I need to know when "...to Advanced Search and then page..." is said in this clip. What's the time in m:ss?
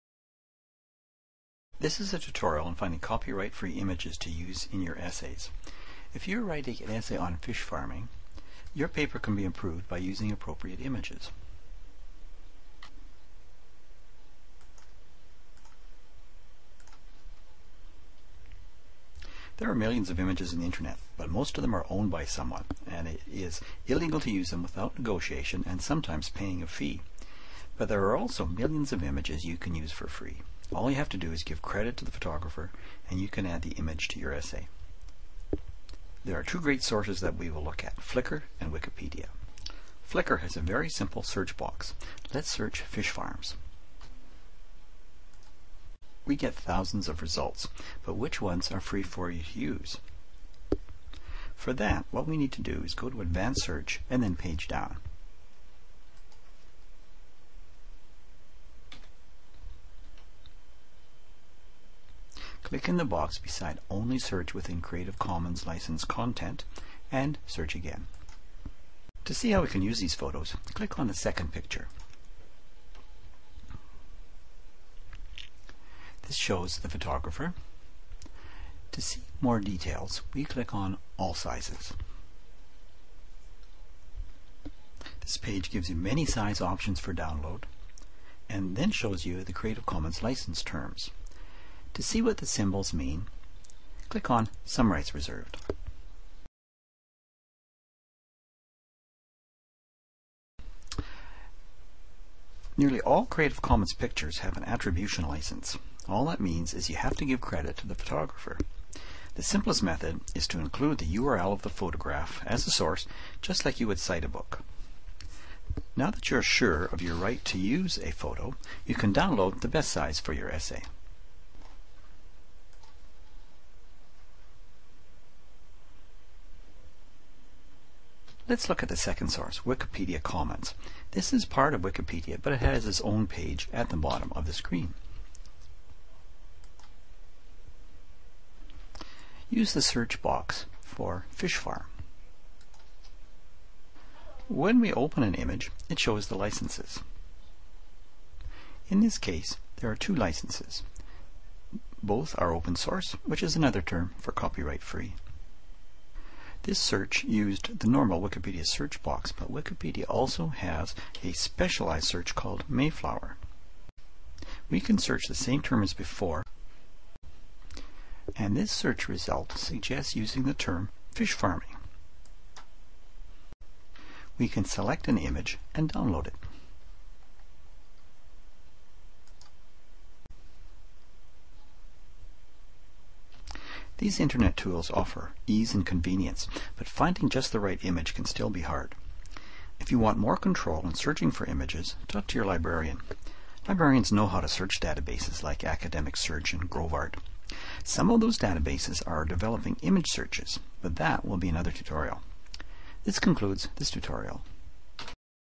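0:53.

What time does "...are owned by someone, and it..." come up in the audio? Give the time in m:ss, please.
0:21.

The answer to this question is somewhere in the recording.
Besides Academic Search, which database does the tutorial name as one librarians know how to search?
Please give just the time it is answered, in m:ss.
3:16.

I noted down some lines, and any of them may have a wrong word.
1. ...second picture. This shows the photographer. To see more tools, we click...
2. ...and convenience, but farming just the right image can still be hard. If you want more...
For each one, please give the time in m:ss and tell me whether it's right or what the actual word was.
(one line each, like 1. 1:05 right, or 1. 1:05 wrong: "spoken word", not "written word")
1. 1:11 wrong: "details", not "tools"
2. 3:05 wrong: "finding", not "farming".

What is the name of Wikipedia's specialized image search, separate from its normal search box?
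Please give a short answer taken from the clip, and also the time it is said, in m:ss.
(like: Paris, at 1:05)
Mayflower, at 2:42.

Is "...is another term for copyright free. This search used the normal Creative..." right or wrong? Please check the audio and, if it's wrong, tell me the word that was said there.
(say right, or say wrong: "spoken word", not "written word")
wrong: "Wikipedia", not "Creative".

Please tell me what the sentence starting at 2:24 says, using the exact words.
When we open an image, it shows the licenses.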